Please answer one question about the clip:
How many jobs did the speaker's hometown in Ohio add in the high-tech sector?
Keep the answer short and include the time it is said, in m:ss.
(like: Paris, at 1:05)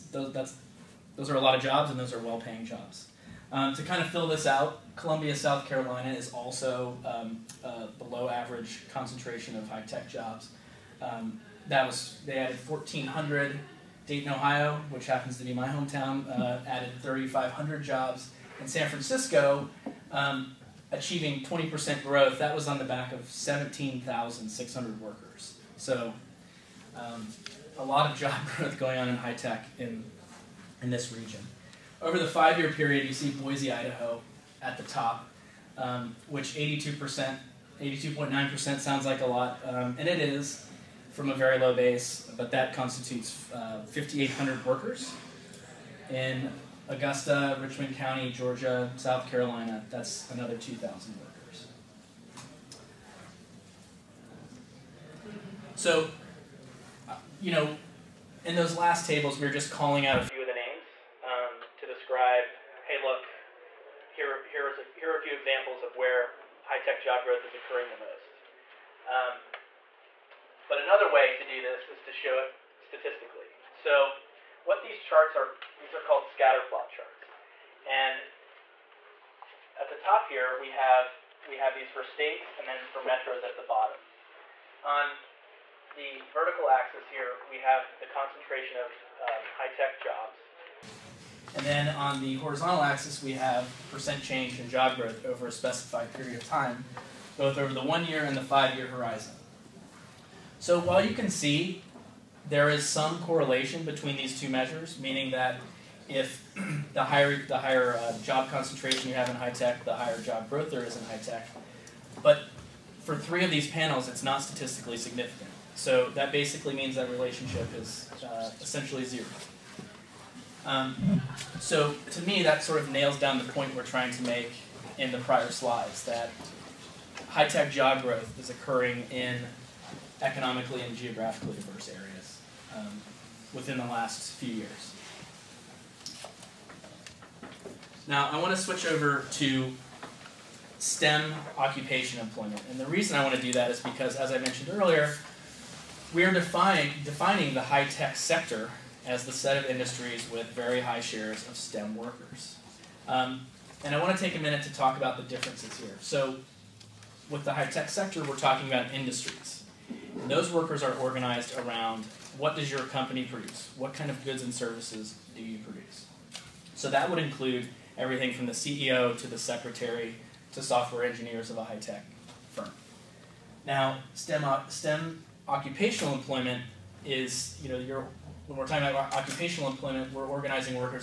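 3,500, at 0:17.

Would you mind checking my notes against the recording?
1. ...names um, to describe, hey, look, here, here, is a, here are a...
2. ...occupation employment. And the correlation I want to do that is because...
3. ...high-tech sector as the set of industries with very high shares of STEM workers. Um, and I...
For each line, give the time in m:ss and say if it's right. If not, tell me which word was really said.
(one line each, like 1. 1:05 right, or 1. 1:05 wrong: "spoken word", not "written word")
1. 1:00 right
2. 2:21 wrong: "reason", not "correlation"
3. 2:27 right.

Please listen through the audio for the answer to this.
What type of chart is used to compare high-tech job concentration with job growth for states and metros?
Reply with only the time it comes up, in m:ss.
1:16.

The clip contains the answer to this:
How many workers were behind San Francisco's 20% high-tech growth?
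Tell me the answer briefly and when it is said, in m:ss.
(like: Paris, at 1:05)
17,600, at 0:23.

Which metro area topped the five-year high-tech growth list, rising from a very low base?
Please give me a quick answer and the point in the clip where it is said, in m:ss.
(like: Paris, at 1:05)
Boise, Idaho, at 0:33.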